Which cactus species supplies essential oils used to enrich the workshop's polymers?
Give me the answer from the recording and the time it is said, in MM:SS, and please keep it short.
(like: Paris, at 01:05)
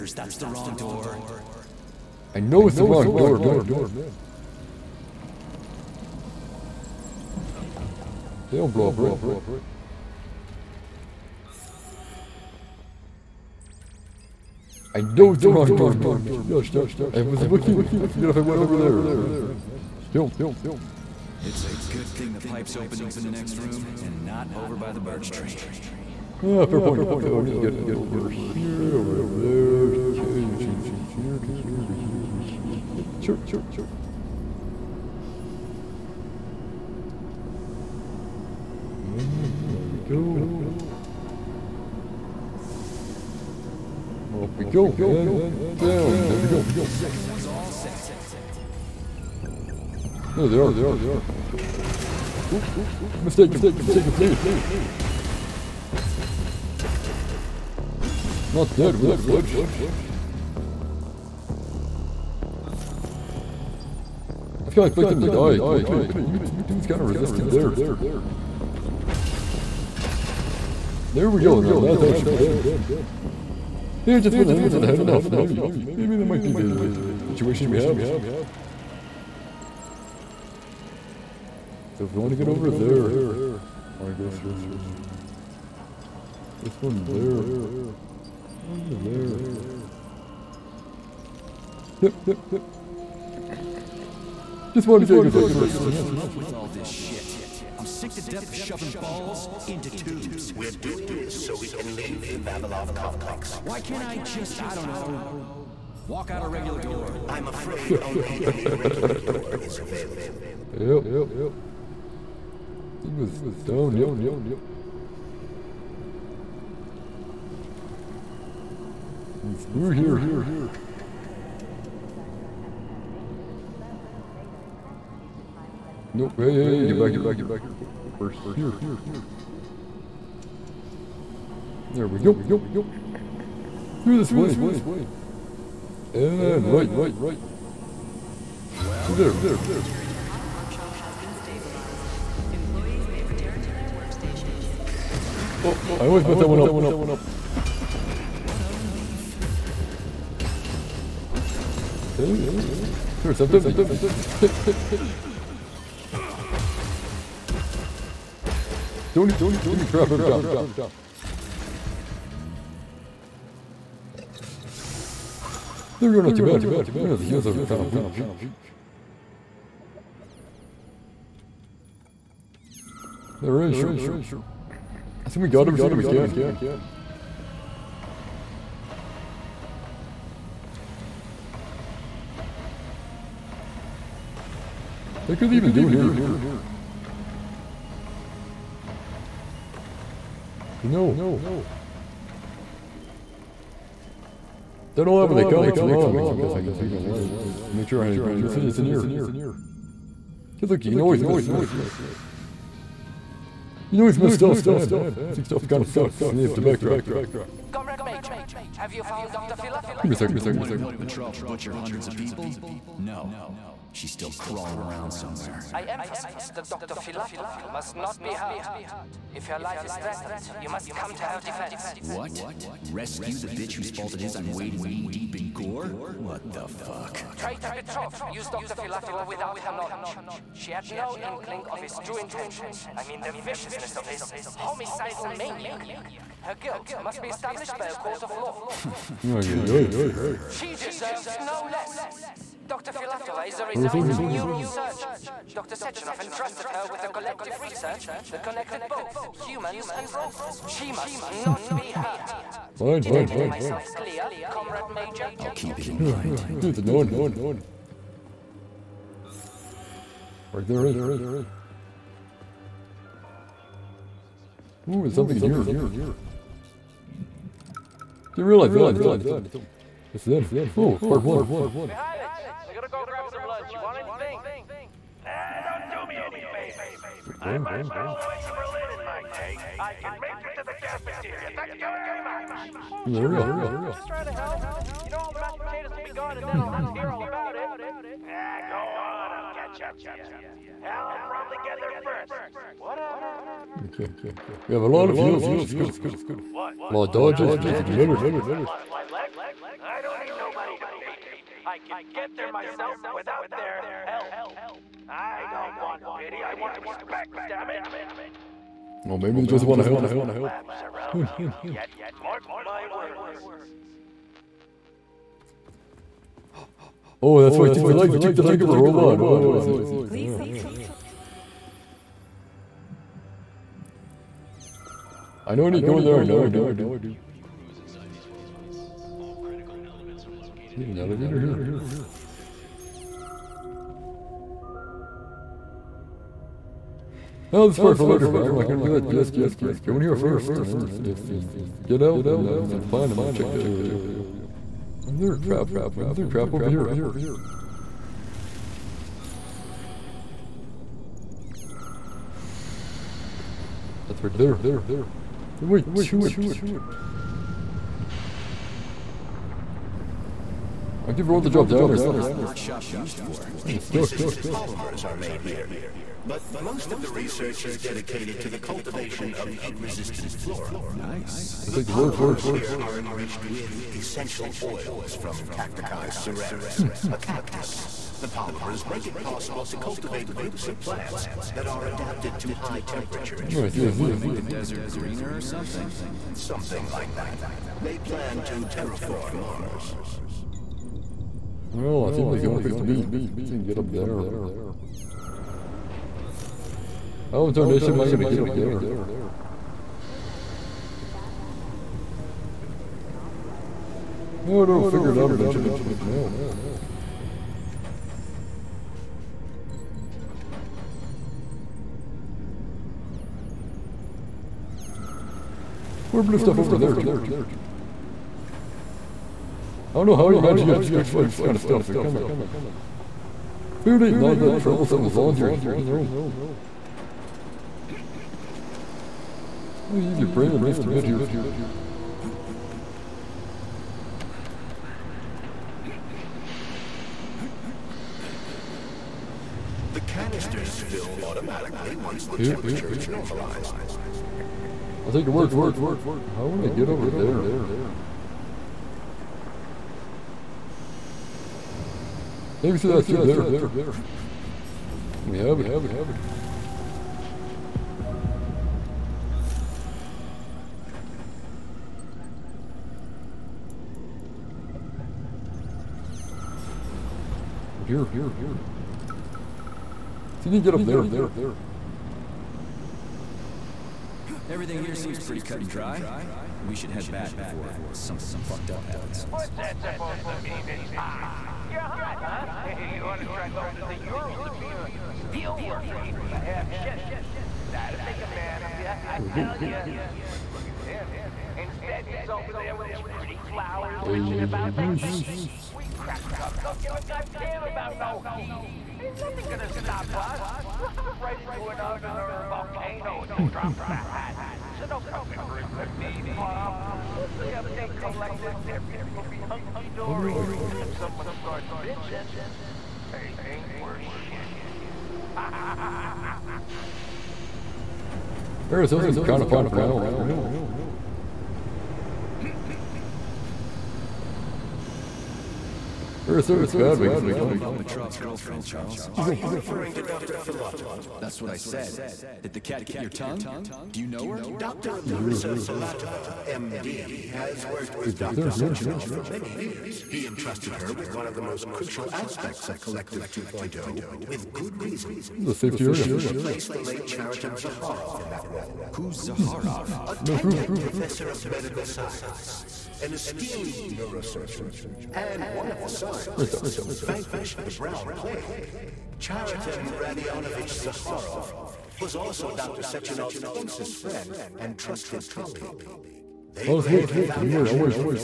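Cacticus cereris, at 06:15.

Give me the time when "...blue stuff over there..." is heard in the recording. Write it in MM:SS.
06:56.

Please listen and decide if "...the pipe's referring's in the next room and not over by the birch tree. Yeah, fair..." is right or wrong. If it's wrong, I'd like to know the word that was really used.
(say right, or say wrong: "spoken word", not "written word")
wrong: "opening", not "referring".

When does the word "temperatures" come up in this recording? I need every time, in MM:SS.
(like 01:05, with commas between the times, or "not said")
06:22, 07:22.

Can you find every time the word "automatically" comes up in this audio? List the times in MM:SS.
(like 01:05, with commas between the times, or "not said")
07:21.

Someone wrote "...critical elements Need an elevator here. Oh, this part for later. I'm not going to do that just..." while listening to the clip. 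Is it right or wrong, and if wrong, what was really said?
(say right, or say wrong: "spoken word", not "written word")
right.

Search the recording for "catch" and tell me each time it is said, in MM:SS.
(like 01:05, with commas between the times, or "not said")
04:49.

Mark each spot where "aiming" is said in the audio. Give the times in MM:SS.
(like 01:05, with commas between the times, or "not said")
01:14.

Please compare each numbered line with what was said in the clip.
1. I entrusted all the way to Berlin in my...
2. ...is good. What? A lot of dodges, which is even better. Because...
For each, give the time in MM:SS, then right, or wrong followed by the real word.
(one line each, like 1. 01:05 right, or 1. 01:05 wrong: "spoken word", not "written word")
1. 04:37 wrong: "marched", not "entrusted"
2. 04:55 right.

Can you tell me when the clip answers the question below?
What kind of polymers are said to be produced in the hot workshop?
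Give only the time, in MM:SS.
06:03.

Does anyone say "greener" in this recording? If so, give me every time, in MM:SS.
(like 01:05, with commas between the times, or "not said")
06:24.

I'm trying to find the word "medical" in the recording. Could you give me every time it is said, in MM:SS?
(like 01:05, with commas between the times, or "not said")
09:11.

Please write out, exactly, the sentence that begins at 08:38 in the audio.
Arizona seems kind of fun for now.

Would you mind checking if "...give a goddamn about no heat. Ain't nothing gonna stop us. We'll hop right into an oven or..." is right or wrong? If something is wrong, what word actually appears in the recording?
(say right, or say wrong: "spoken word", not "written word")
right.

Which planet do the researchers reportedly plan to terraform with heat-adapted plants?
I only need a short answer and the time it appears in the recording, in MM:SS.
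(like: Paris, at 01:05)
Mars, at 06:29.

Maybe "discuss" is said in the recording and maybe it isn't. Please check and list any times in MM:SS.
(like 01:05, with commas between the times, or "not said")
not said.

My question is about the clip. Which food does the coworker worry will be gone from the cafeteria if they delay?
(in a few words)
mashed potatoes.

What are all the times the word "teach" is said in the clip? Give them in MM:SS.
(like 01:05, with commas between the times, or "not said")
not said.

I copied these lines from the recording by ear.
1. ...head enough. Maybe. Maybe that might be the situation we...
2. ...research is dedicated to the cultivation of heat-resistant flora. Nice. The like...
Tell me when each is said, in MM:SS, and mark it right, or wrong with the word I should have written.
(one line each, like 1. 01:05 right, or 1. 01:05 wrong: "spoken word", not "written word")
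1. 01:14 right
2. 06:07 right.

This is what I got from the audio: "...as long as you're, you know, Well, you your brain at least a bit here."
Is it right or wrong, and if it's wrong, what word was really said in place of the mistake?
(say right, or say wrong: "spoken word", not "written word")
right.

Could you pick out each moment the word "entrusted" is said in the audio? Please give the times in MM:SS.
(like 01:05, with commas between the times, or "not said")
04:06, 09:00.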